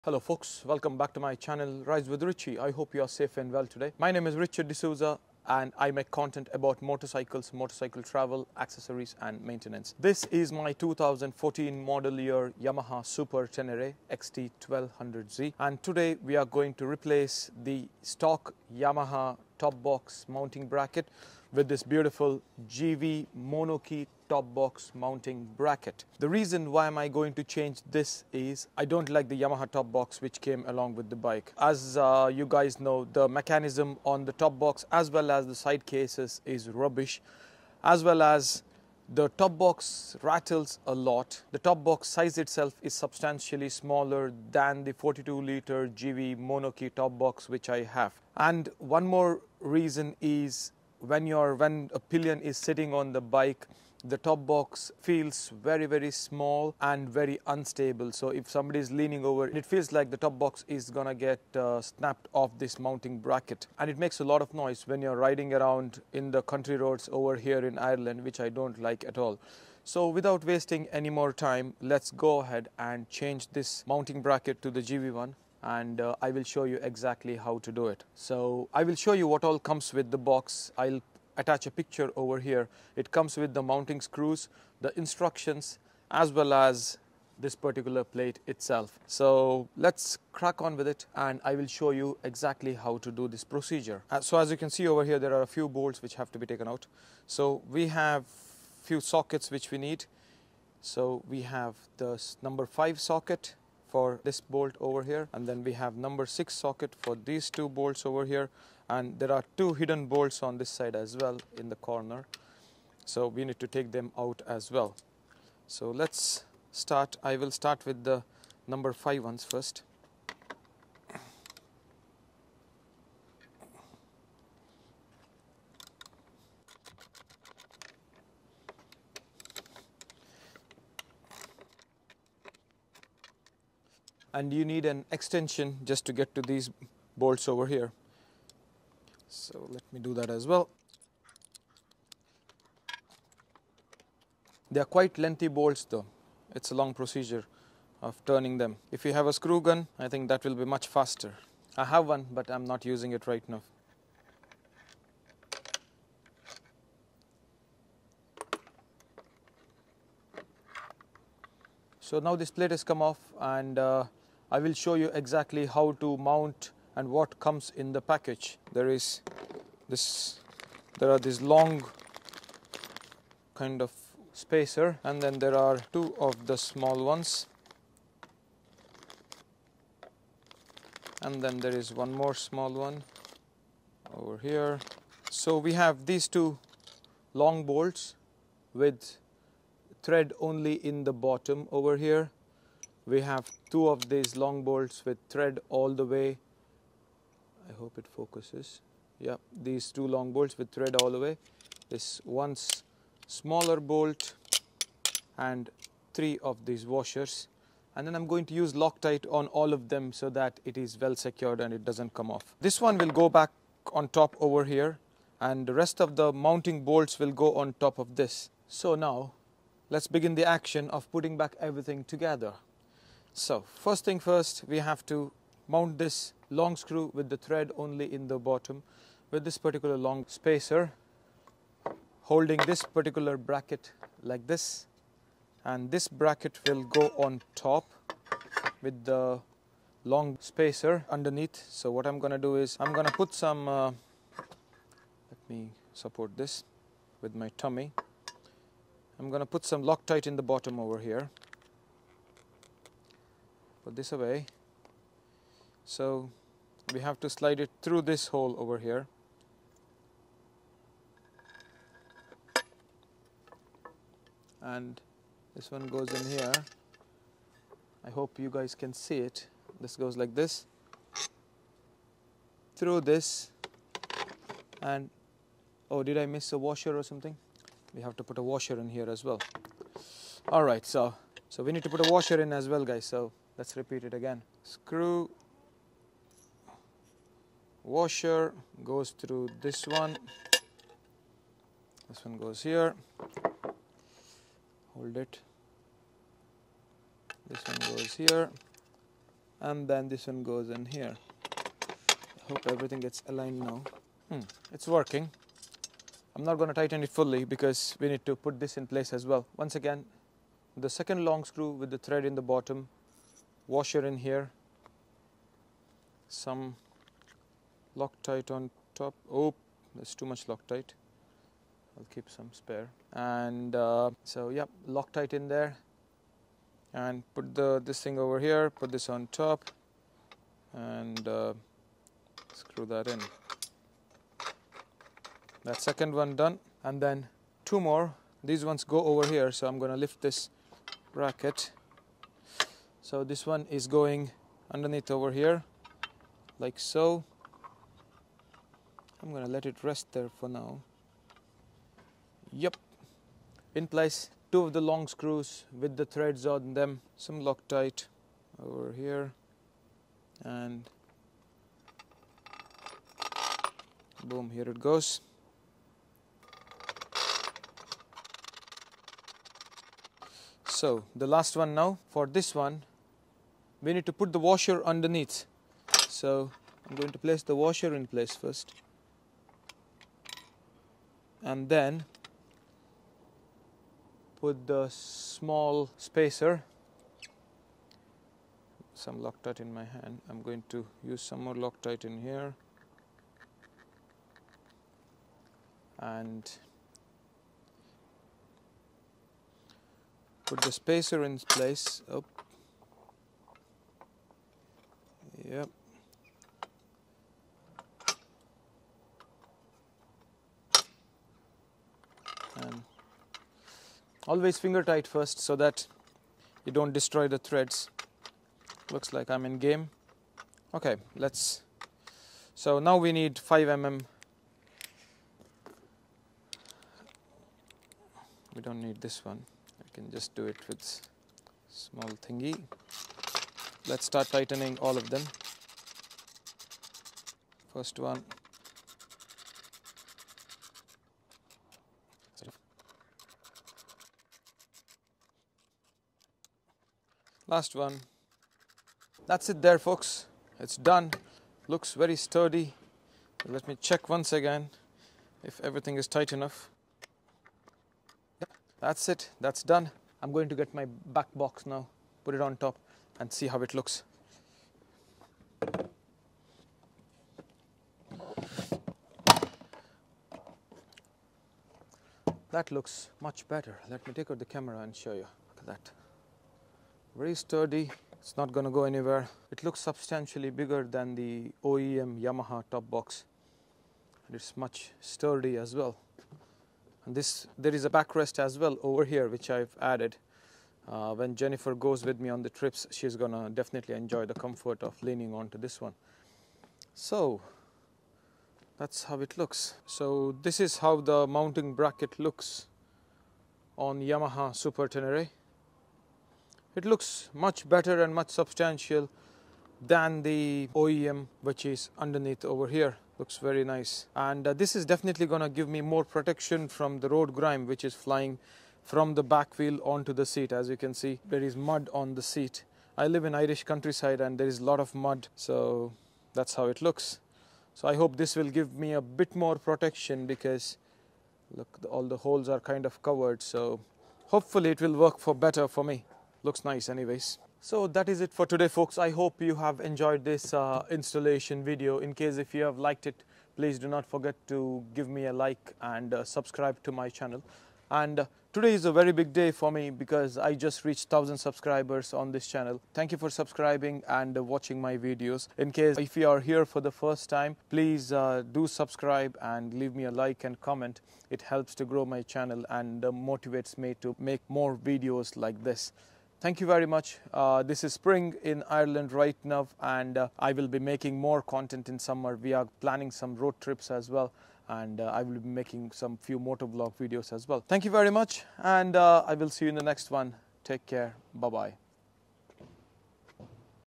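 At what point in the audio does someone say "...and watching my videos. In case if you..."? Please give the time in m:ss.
9:14.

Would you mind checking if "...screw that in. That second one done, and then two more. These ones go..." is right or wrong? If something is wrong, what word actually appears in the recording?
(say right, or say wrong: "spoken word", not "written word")
right.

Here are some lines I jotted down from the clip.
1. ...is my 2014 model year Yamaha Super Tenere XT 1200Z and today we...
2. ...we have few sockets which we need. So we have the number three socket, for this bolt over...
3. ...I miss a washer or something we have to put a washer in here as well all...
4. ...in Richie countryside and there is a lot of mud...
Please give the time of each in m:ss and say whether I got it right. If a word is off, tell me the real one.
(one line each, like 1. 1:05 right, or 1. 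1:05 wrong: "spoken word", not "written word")
1. 0:10 right
2. 1:37 wrong: "five", not "three"
3. 4:36 right
4. 8:43 wrong: "Irish", not "Richie".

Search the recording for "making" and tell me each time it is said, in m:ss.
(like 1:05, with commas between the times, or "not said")
9:30, 9:35.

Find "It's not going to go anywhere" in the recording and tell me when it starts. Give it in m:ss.
7:58.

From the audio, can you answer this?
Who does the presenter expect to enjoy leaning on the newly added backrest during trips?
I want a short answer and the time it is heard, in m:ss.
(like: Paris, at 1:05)
Jennifer, at 8:11.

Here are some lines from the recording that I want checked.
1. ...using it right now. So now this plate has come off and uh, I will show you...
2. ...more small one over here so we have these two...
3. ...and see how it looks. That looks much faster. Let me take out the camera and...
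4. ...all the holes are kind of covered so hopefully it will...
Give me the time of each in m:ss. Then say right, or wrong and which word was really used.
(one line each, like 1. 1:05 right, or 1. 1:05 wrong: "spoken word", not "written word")
1. 2:32 right
2. 3:02 right
3. 7:43 wrong: "better", not "faster"
4. 8:51 right.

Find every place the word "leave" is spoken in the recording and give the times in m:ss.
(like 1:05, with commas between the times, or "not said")
9:19.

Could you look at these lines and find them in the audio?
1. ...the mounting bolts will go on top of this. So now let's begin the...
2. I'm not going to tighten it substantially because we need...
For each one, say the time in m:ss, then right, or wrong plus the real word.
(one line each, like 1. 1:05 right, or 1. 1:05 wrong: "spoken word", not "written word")
1. 3:36 right
2. 5:06 wrong: "fully", not "substantially".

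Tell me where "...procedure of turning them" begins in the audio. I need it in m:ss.
2:26.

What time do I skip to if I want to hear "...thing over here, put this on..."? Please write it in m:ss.
5:28.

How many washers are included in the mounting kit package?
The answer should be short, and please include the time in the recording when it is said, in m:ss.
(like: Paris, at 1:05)
3, at 3:26.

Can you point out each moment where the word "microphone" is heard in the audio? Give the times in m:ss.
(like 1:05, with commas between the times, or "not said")
not said.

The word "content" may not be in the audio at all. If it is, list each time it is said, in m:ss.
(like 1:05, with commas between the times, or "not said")
0:06, 9:31.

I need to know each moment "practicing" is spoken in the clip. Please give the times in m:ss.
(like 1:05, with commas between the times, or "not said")
not said.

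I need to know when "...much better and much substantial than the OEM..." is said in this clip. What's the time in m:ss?
8:27.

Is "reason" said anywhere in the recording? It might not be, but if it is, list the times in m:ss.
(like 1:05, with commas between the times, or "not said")
0:26, 0:49.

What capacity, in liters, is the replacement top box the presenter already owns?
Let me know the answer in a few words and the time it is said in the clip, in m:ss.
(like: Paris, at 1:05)
42 liters, at 0:44.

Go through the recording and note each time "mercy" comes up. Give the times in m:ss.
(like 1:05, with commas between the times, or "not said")
not said.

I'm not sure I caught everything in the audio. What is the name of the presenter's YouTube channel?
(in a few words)
Rides with Richie.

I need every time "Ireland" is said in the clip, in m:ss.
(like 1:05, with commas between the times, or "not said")
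1:07, 9:28.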